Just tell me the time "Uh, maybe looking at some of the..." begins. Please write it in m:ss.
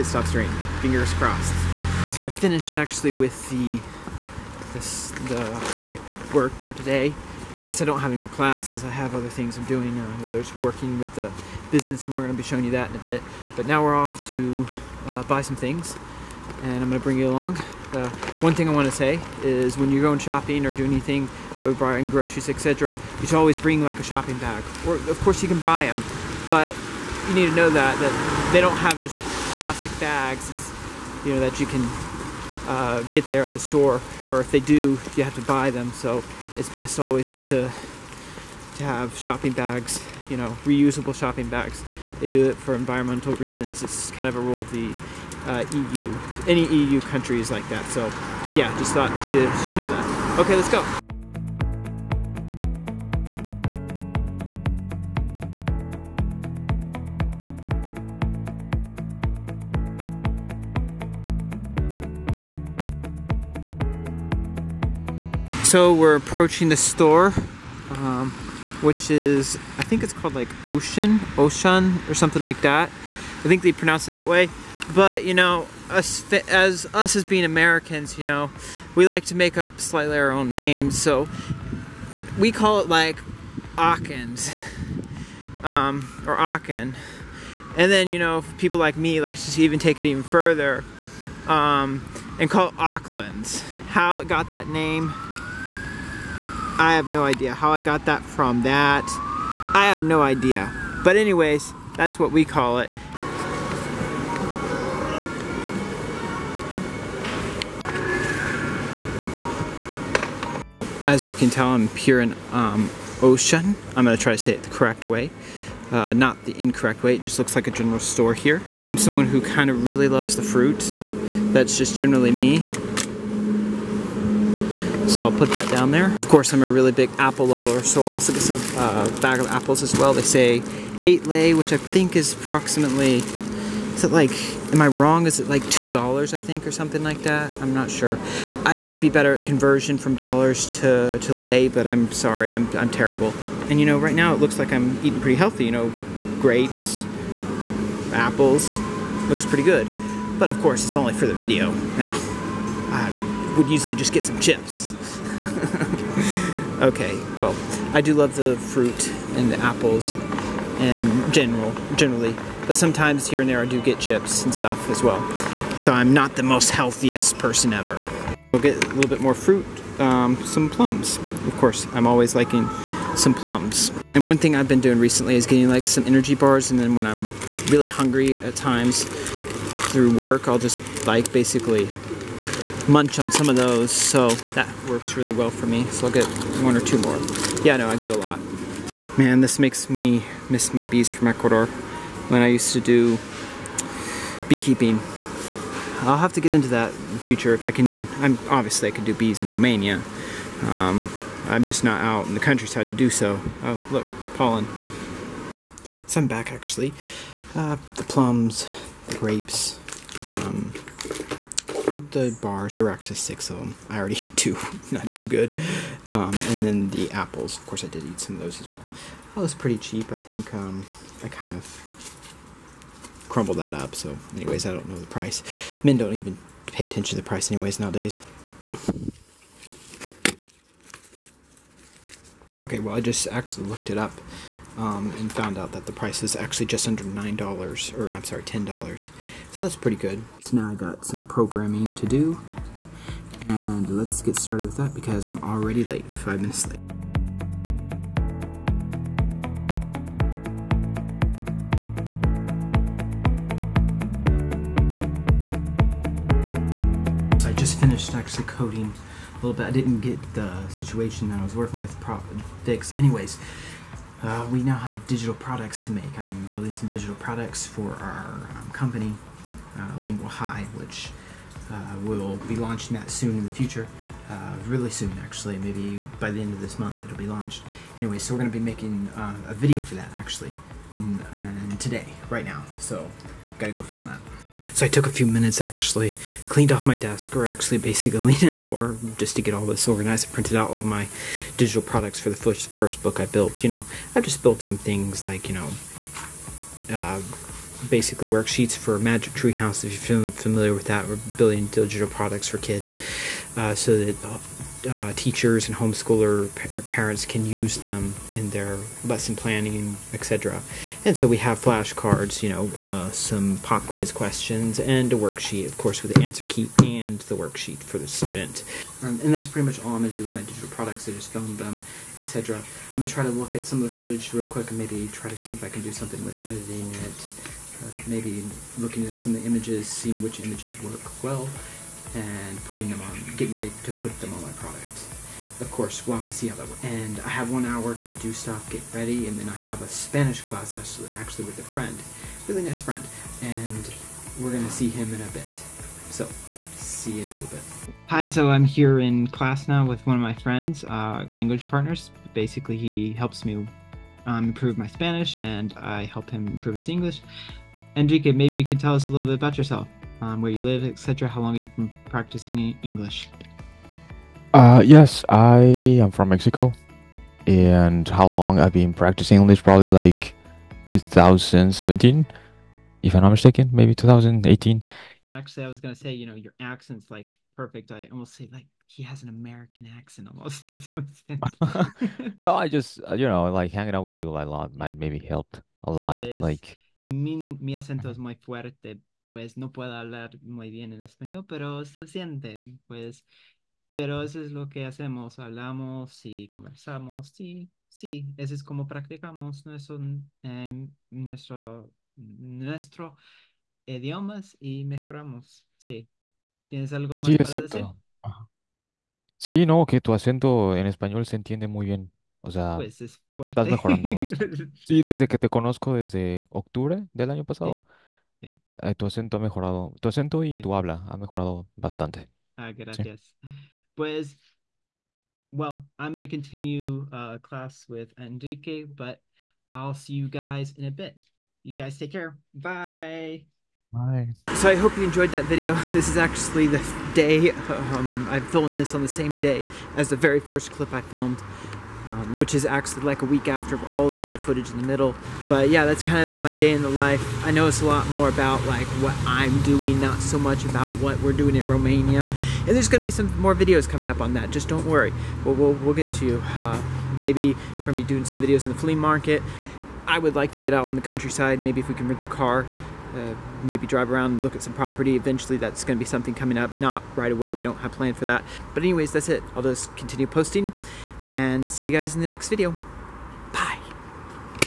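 5:27.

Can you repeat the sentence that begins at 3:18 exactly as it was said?
I'm obviously I could do bees in Romania.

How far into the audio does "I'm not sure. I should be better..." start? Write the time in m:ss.
2:17.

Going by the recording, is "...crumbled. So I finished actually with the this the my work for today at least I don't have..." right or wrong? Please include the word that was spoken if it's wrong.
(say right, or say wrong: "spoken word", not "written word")
wrong: "crossed", not "crumbled".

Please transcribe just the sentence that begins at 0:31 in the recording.
you know that you can uh, get there at the store, or if they do, you have to buy them.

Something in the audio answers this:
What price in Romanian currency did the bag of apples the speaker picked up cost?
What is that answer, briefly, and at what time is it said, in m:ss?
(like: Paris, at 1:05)
8 lei, at 2:11.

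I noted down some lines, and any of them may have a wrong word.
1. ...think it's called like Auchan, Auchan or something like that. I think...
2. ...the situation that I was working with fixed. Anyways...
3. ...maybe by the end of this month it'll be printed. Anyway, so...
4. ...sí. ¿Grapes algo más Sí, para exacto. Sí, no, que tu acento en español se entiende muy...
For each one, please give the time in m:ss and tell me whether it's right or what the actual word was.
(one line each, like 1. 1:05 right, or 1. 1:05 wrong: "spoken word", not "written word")
1. 1:09 right
2. 4:20 right
3. 4:35 wrong: "launched", not "printed"
4. 6:45 wrong: "Tienes", not "Grapes".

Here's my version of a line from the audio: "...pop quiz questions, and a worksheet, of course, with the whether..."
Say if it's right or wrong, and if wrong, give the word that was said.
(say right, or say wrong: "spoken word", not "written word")
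wrong: "answer", not "whether".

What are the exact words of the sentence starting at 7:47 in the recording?
We don't have plan for that.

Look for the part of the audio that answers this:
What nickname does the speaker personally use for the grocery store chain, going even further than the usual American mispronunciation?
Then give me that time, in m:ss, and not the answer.
1:32.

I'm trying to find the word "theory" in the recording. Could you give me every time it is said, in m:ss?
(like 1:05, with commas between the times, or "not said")
not said.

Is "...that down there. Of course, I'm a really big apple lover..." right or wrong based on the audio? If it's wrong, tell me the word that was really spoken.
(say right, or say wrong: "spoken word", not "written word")
right.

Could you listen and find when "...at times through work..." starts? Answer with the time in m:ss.
2:58.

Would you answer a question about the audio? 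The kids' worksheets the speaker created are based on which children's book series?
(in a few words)
Magic Tree House.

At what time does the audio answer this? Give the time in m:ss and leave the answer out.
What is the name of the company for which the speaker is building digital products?
4:29.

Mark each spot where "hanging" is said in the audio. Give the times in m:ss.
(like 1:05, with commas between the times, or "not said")
6:23.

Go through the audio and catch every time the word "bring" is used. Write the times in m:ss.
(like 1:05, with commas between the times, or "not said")
0:16, 0:23.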